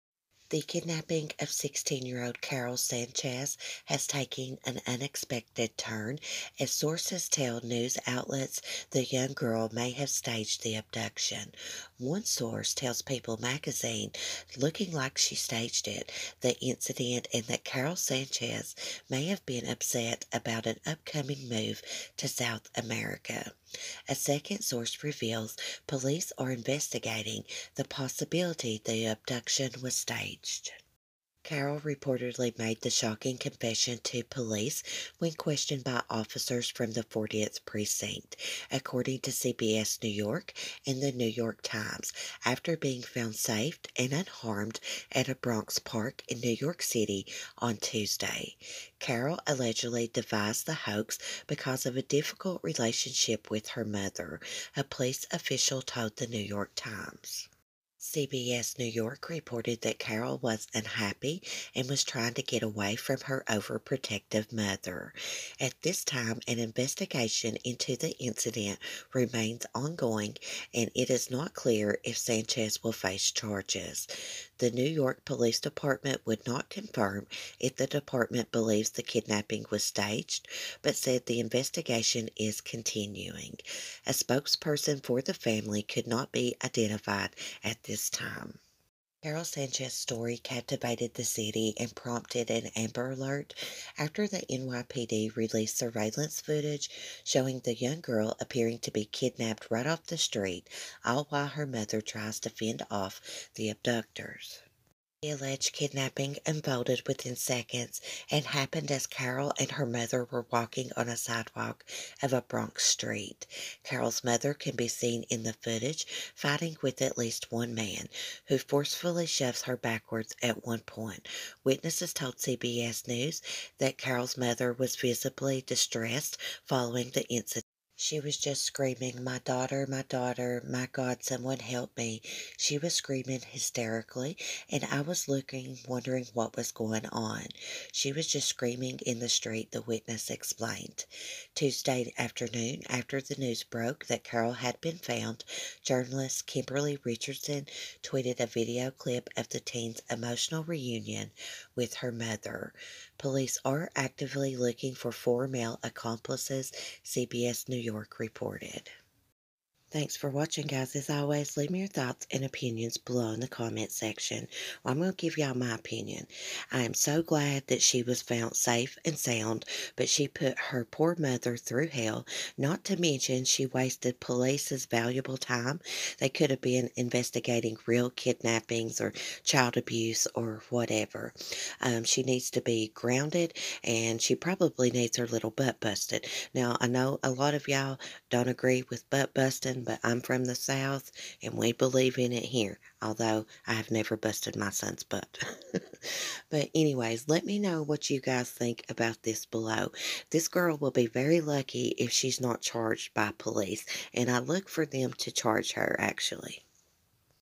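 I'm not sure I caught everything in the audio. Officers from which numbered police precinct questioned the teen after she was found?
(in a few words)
40th Precinct.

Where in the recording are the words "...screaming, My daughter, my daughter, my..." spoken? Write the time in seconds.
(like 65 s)
128 s.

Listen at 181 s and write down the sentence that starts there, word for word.
Um, she needs to be grounded, and she probably needs her little butt busted.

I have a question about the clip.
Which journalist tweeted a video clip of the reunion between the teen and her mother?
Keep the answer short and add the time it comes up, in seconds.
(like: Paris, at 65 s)
Kemberly Richardson, at 146 s.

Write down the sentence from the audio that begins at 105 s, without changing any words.
The alleged kidnapping unfolded within seconds and happened as Karol and her mother were walking on a sidewalk of a Bronx street.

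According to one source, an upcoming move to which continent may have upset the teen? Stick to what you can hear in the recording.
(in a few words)
South America.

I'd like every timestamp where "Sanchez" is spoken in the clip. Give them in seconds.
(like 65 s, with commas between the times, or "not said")
2 s, 17 s, 72 s, 89 s.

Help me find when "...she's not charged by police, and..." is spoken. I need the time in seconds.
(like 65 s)
202 s.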